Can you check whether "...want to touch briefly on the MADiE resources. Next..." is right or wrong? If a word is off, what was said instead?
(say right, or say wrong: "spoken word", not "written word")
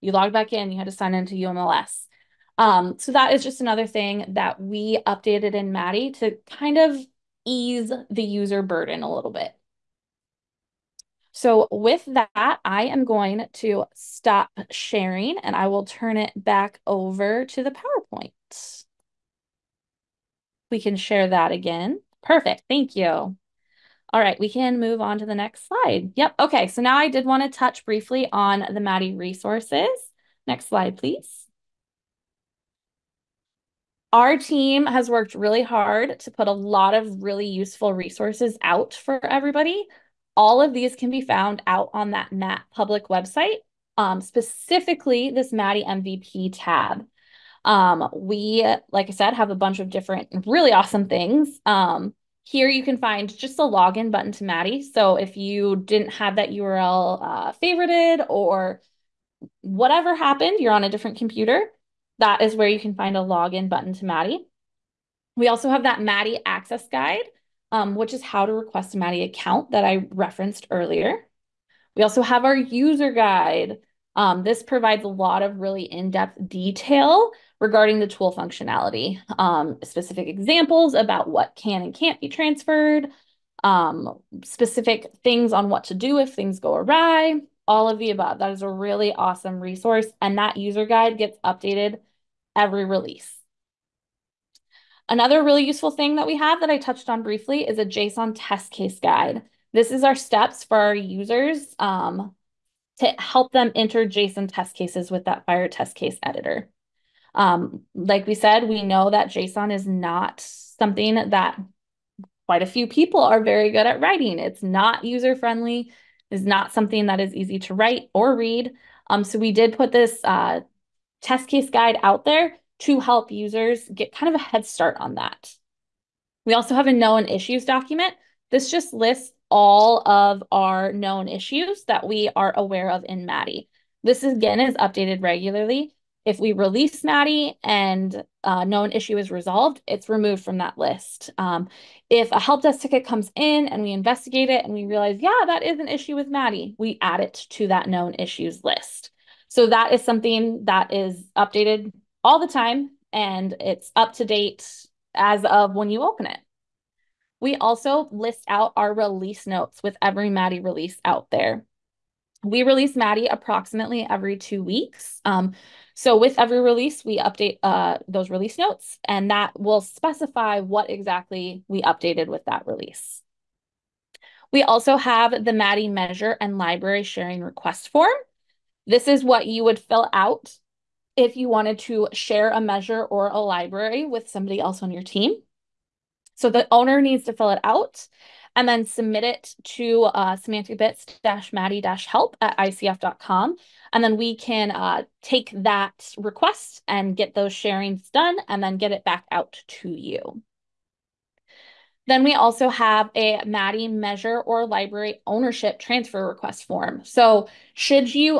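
right.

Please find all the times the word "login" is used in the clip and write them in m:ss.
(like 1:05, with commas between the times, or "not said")
0:53, 1:03.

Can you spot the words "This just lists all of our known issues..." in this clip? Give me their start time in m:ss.
2:08.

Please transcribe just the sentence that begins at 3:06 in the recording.
So the owner needs to fill it out and then submit it to uh, semanticbits-maddie-help at icf.com.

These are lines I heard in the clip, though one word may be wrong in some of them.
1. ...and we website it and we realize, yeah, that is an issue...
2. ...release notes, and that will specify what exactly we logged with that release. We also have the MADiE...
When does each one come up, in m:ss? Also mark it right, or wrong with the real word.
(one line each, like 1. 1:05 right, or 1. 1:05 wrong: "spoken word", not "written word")
1. 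2:23 wrong: "investigate", not "website"
2. 2:48 wrong: "updated", not "logged".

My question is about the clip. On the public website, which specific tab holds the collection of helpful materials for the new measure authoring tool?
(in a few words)
MADiE MVP.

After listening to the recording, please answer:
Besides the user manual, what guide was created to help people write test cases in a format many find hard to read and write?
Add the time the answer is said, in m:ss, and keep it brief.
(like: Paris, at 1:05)
JSON test case guide, at 1:37.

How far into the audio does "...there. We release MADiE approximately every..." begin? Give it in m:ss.
2:41.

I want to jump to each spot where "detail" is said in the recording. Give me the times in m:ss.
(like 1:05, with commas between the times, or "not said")
1:16.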